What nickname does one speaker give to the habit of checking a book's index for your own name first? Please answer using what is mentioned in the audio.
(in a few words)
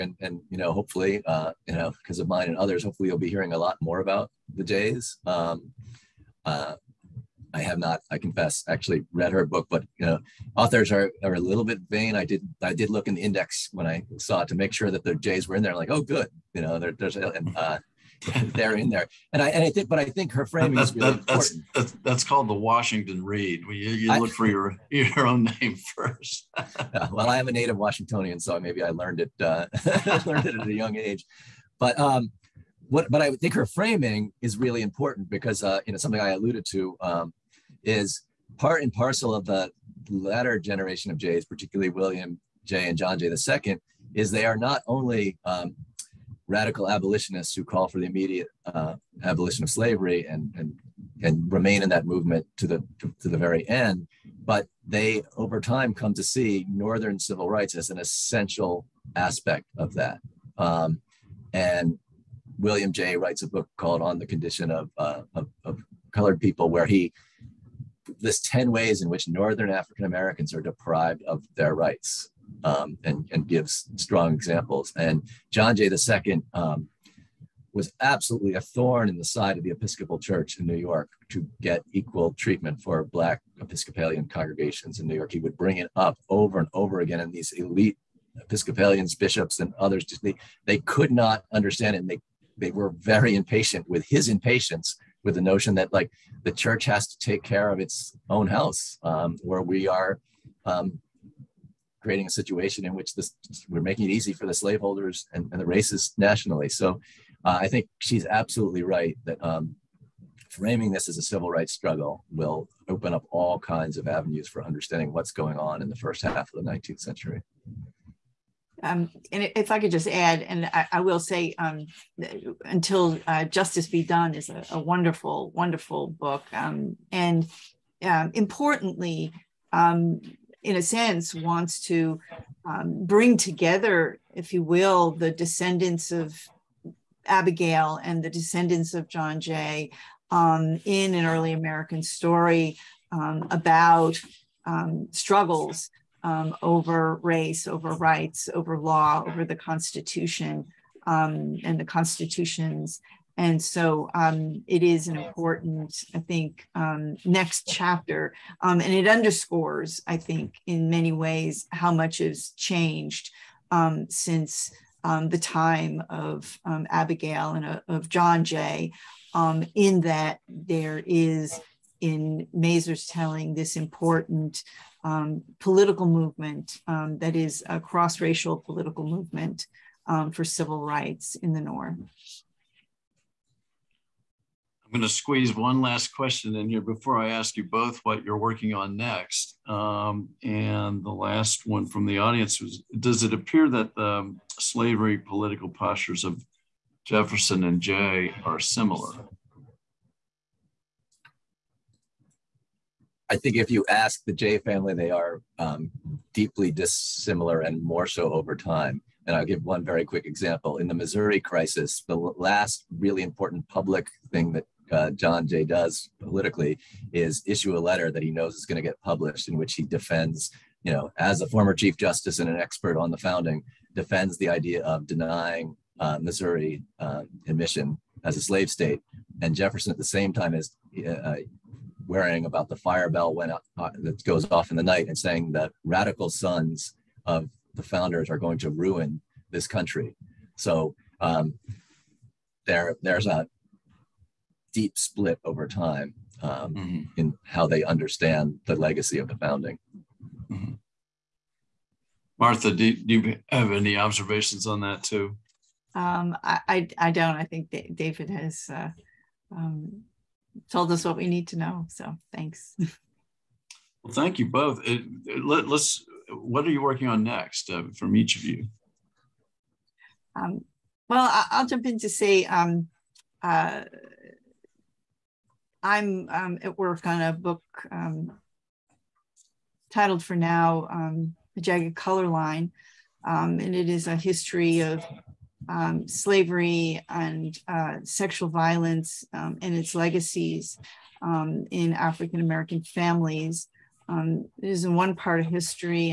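The Washington Read.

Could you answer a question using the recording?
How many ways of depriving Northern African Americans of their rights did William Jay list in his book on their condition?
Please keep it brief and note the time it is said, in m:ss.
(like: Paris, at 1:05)
10, at 1:08.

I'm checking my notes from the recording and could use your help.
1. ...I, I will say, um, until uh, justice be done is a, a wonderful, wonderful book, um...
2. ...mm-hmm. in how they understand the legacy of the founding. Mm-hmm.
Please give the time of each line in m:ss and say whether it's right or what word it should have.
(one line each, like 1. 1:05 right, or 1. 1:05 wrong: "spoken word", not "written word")
1. 2:00 right
2. 4:06 right.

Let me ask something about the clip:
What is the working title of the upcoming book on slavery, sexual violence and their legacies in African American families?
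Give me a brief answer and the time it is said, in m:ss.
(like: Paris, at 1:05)
The Jagged Color Line, at 4:41.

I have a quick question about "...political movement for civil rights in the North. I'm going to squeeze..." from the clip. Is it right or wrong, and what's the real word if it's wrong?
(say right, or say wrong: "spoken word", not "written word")
right.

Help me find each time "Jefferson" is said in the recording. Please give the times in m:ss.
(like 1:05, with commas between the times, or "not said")
3:17, 3:49.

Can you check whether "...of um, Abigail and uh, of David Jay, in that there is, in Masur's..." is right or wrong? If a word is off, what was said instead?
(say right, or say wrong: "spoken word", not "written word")
wrong: "John", not "David".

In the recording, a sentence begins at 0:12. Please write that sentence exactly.
I did I did look in the index when I saw it to make sure that the Jays were in there.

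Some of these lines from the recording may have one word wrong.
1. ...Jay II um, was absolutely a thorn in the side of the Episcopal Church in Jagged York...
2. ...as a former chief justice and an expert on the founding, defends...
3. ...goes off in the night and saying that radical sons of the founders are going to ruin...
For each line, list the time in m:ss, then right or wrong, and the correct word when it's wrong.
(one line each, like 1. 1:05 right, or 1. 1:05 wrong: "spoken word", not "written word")
1. 1:15 wrong: "New", not "Jagged"
2. 3:41 right
3. 3:54 right.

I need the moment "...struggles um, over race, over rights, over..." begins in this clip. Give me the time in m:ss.
2:25.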